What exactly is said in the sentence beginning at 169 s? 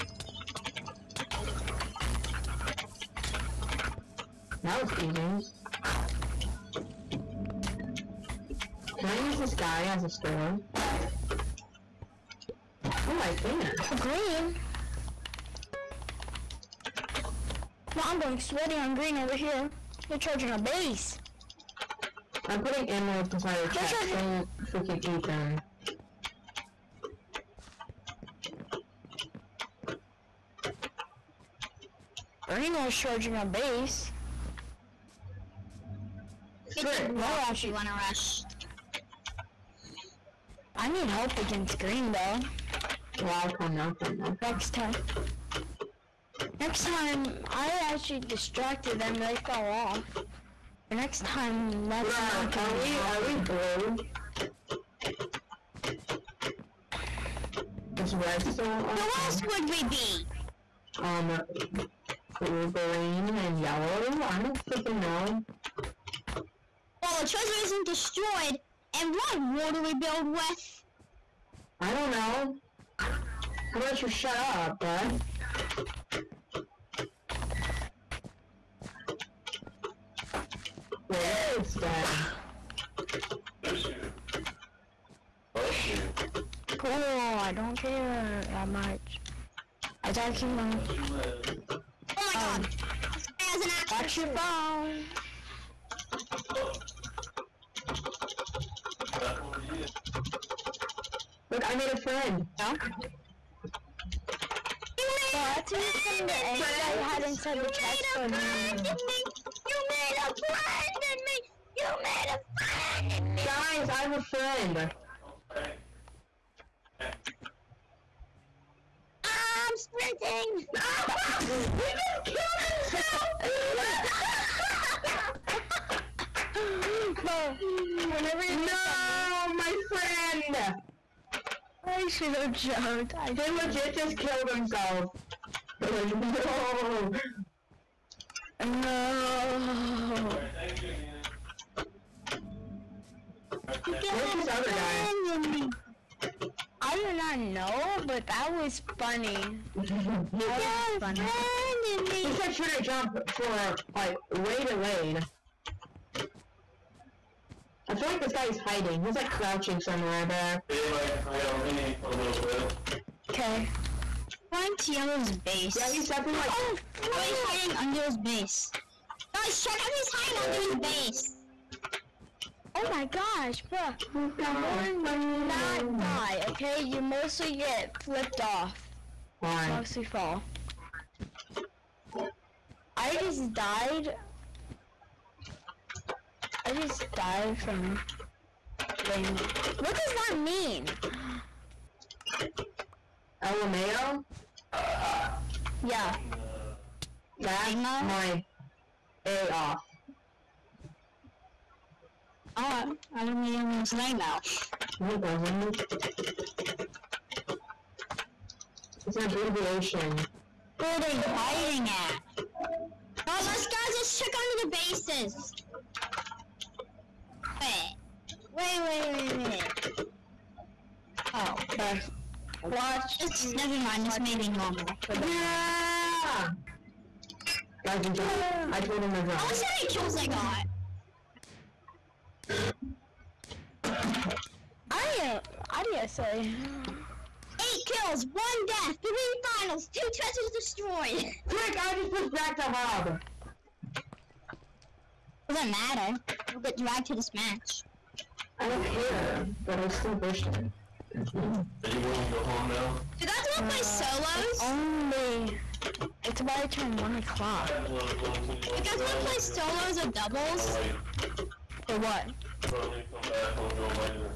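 Guys, check out he's hiding under his base.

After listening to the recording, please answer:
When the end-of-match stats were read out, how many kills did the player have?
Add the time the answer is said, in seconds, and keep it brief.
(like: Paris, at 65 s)
8, at 236 s.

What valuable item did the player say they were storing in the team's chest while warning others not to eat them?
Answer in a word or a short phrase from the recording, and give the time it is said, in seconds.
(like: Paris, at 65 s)
emeralds, at 22 s.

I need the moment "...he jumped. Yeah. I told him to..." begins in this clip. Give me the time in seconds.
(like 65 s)
228 s.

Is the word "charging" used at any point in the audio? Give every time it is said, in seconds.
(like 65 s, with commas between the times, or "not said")
20 s, 32 s.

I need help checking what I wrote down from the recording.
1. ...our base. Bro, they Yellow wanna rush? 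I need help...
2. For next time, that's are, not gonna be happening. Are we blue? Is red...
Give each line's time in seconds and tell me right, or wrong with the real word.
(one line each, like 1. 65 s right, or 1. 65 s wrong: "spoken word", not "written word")
1. 33 s wrong: "You", not "Yellow"
2. 50 s right.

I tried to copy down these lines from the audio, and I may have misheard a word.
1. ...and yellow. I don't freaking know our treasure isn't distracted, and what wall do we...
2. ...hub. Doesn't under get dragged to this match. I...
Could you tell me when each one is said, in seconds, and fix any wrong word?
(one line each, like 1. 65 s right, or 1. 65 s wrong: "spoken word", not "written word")
1. 63 s wrong: "destroyed", not "distracted"
2. 242 s wrong: "matter", not "under".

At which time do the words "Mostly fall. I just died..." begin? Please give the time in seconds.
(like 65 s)
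179 s.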